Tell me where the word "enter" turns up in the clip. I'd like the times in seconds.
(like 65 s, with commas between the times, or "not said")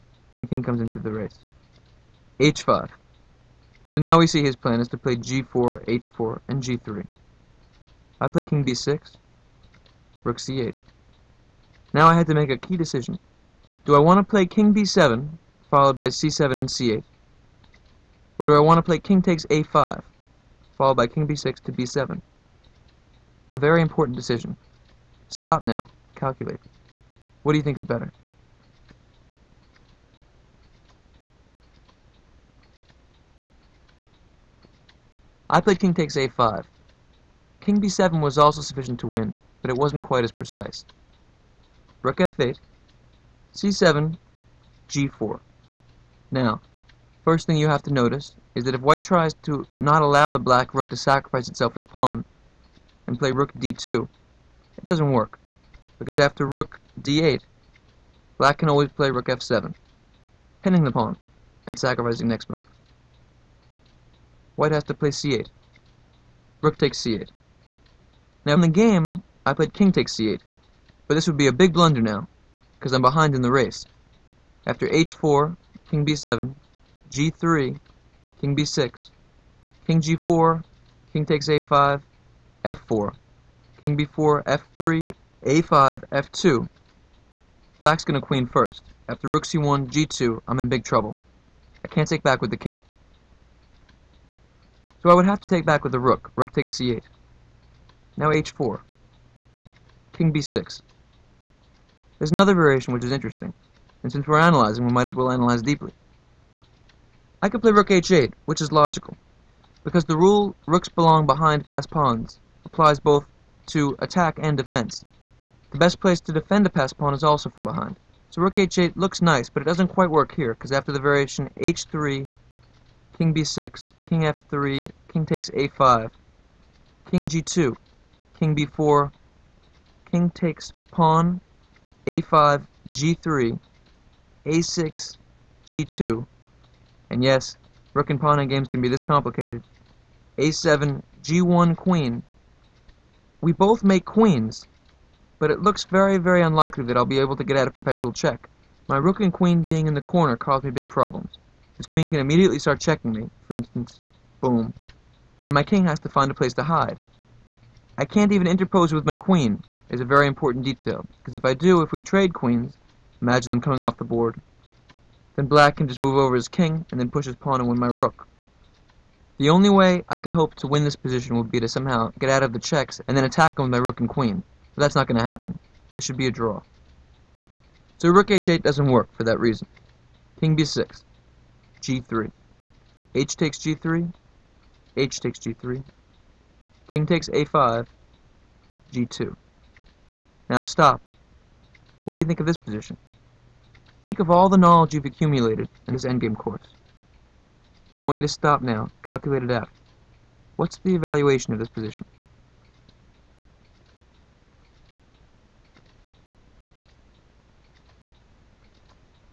not said.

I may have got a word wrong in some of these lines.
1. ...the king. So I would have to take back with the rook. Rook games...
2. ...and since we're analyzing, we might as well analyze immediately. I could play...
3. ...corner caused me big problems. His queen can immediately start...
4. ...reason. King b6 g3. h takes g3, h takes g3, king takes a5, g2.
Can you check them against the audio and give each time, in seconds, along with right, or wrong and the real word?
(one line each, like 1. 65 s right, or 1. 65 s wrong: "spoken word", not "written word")
1. 92 s wrong: "takes", not "games"
2. 104 s wrong: "deeply", not "immediately"
3. 150 s right
4. 179 s right.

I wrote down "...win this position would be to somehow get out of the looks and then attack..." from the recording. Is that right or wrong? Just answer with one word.
wrong.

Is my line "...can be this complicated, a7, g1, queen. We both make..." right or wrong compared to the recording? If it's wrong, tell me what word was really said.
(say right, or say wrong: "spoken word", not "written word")
right.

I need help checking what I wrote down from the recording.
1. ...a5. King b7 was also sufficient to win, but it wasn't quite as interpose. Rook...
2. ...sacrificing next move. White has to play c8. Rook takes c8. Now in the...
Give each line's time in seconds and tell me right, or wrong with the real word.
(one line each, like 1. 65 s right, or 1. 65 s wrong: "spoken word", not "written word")
1. 36 s wrong: "precise", not "interpose"
2. 61 s right.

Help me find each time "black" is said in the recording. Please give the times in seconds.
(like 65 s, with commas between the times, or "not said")
50 s, 58 s, 87 s, 165 s.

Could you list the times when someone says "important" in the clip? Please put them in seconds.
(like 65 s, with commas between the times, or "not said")
23 s, 160 s.